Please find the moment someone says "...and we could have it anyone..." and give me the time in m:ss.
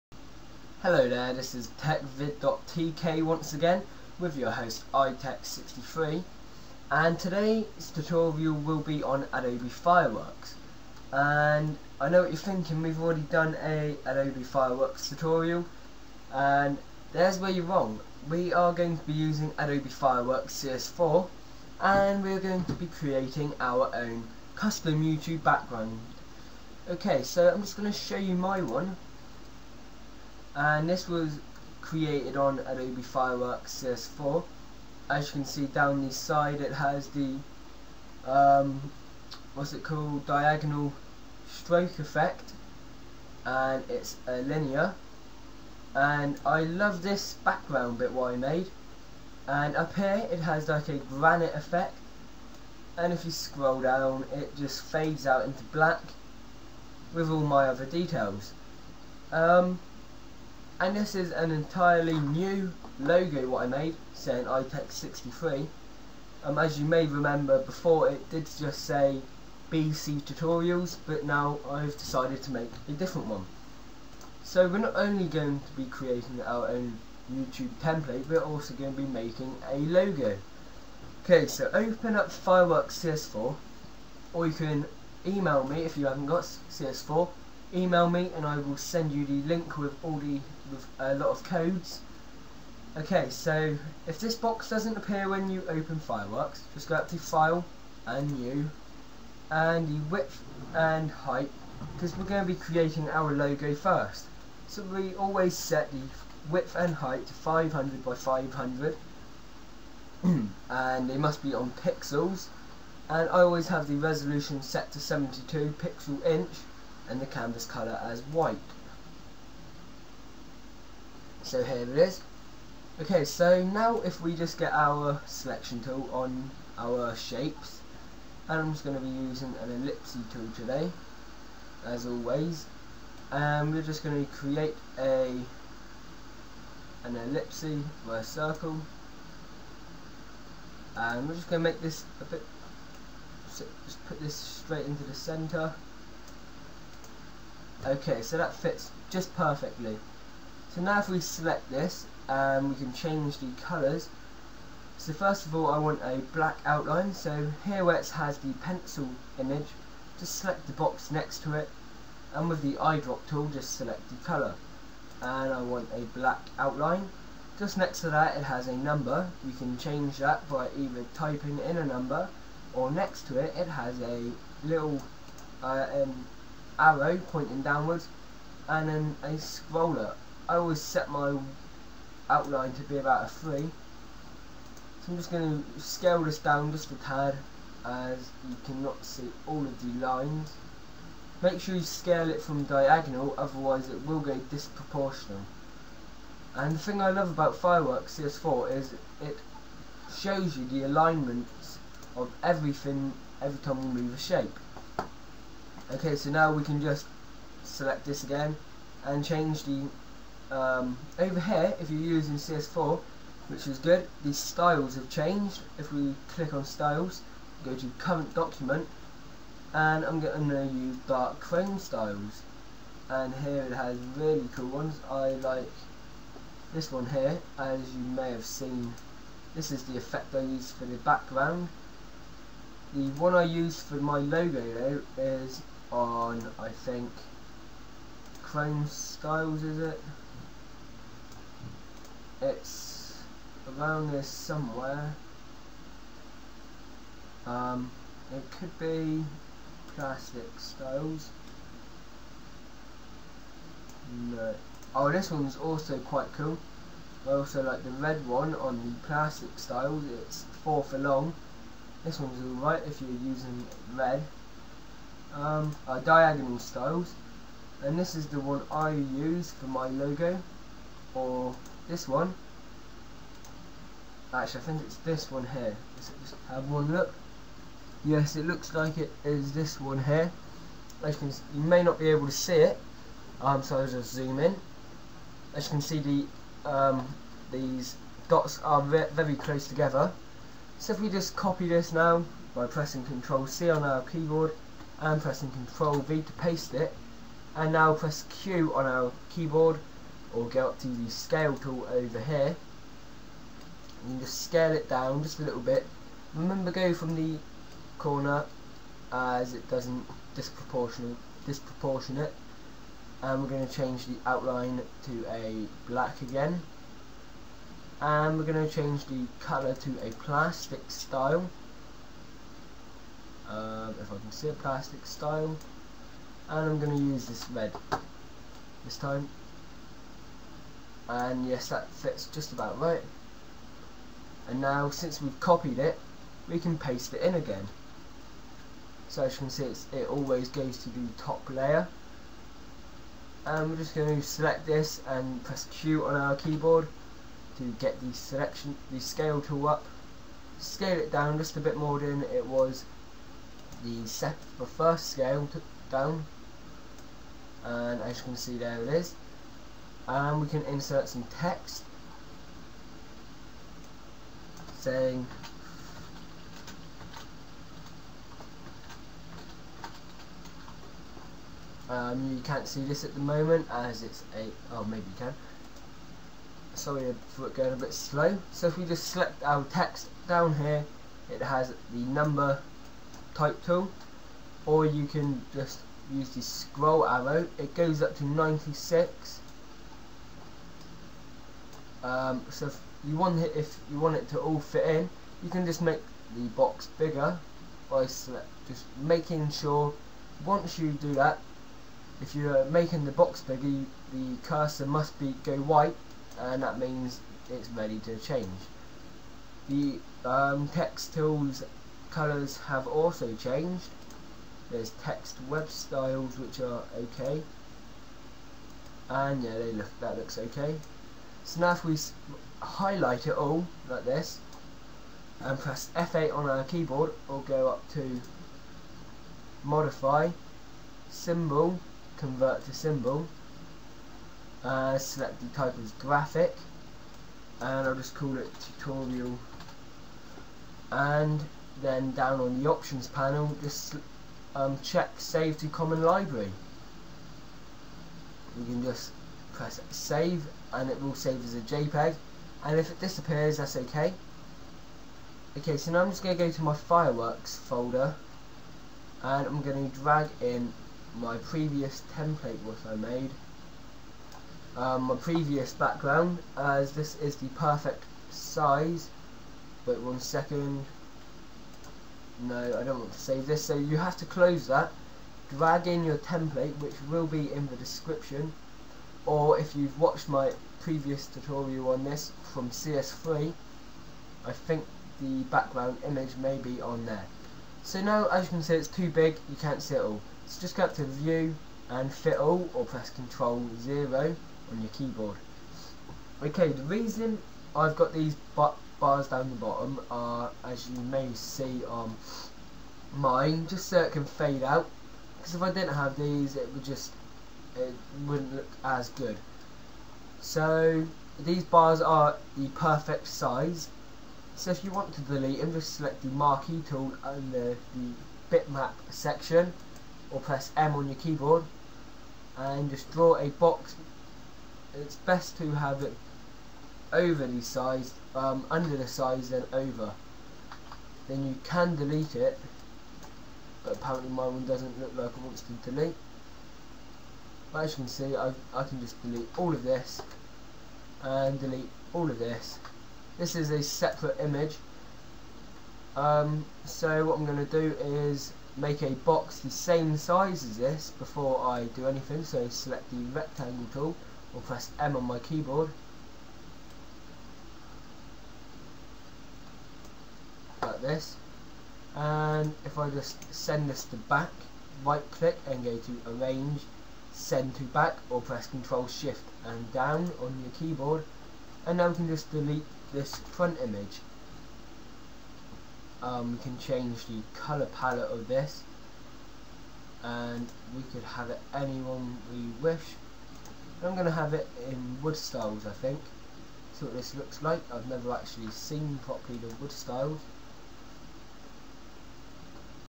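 9:40.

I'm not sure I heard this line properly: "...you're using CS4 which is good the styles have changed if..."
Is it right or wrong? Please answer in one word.
right.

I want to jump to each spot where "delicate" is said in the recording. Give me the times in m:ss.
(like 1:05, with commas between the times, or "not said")
not said.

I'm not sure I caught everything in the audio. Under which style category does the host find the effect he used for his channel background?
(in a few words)
Dark chrome styles.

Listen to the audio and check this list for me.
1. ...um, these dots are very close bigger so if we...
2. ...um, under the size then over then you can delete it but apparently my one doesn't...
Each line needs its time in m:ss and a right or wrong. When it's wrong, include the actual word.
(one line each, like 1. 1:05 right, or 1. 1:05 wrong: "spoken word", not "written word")
1. 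4:46 wrong: "together", not "bigger"
2. 8:48 right.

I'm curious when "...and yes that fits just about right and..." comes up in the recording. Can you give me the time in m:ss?
5:31.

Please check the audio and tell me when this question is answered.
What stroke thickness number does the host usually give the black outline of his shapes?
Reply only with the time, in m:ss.
3:03.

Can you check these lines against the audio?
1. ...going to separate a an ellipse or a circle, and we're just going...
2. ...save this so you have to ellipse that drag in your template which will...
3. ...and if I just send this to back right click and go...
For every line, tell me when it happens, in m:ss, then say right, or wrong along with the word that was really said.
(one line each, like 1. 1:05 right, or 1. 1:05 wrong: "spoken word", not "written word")
1. 2:14 wrong: "create", not "separate"
2. 7:53 wrong: "close", not "ellipse"
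3. 9:22 right.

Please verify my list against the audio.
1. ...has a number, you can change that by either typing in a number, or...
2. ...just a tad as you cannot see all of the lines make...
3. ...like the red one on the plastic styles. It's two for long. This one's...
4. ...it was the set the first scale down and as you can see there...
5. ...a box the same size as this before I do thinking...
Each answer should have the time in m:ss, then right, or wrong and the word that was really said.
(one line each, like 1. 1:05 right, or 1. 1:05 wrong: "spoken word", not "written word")
1. 2:48 right
2. 3:06 right
3. 4:17 wrong: "four", not "two"
4. 5:52 right
5. 9:09 wrong: "anything", not "thinking".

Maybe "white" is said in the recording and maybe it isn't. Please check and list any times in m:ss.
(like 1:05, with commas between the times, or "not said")
1:58, 6:45.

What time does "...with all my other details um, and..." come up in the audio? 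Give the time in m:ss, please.
0:57.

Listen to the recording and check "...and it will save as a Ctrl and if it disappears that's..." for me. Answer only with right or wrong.
wrong.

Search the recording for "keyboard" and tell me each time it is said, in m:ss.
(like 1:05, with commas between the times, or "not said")
4:54, 4:59, 5:46, 7:06, 8:14, 8:41, 9:15, 9:30.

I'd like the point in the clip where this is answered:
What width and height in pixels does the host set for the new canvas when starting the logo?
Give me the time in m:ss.
1:47.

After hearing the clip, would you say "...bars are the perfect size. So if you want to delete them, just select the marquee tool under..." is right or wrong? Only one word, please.
right.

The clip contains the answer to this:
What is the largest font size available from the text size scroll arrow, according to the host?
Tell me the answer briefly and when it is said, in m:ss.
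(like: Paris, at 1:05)
96, at 6:28.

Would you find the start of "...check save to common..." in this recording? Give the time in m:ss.
7:24.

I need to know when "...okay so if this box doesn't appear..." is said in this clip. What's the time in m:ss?
1:32.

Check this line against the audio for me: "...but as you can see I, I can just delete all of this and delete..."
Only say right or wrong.
right.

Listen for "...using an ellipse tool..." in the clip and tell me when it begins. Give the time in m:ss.
2:09.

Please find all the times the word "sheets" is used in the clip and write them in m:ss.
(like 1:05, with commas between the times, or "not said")
not said.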